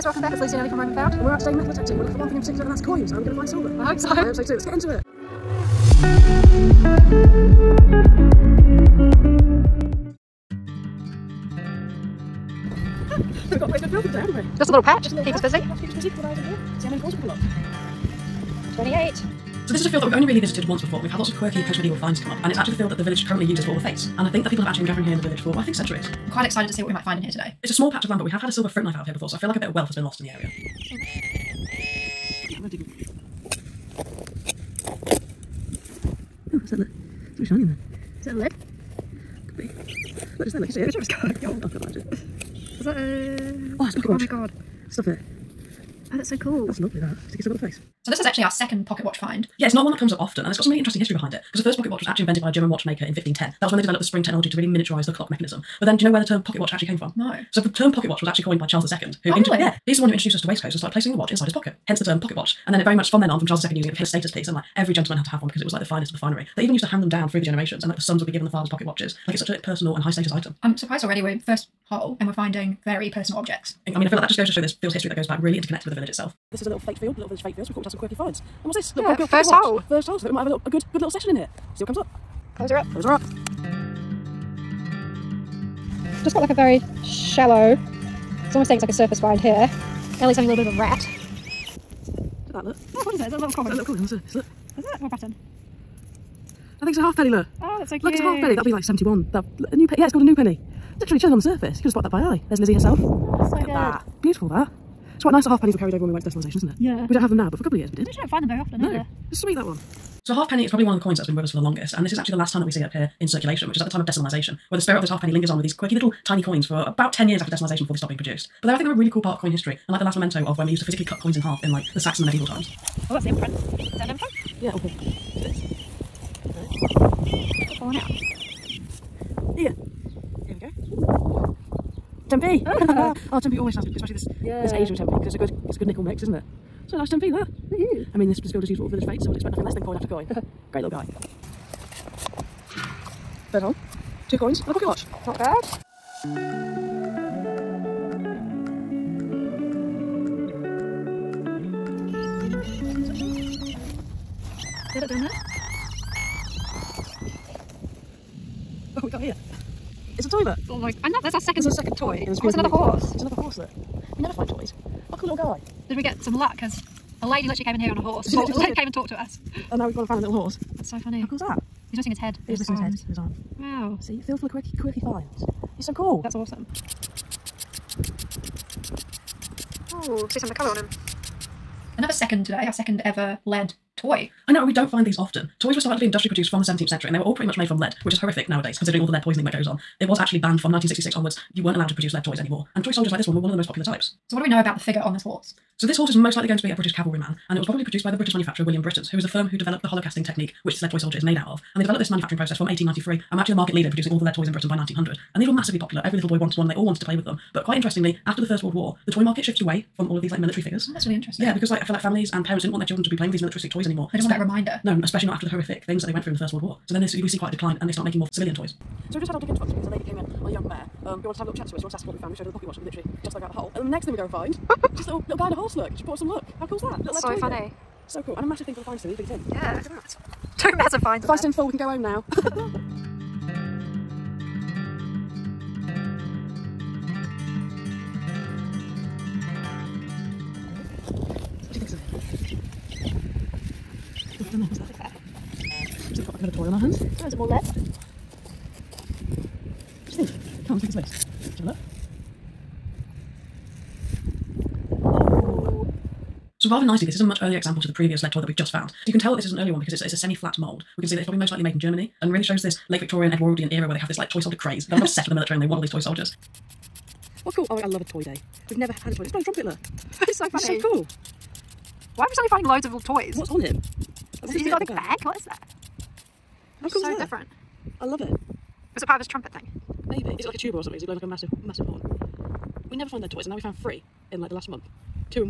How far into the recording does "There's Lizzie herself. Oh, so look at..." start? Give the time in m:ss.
1:42.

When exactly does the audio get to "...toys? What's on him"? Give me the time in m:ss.
4:32.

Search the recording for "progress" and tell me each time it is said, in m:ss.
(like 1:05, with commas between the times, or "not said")
not said.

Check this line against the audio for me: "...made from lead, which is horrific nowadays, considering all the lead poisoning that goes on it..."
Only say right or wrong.
right.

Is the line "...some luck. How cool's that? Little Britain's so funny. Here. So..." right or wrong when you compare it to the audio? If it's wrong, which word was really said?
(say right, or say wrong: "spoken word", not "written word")
wrong: "That", not "Britain".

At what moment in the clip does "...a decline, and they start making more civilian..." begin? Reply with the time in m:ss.
3:37.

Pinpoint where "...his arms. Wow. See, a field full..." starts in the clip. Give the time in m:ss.
2:53.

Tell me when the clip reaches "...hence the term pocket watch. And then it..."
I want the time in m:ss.
1:01.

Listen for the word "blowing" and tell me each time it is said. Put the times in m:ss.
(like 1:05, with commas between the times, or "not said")
4:29, 4:41.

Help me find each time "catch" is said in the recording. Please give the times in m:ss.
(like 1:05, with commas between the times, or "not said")
not said.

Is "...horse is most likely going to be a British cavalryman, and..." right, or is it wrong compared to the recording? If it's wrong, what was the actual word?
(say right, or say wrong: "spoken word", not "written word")
right.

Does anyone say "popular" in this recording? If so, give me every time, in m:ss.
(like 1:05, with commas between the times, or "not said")
3:13, 3:25.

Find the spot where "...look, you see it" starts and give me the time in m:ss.
0:40.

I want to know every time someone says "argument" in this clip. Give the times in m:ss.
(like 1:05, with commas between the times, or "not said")
not said.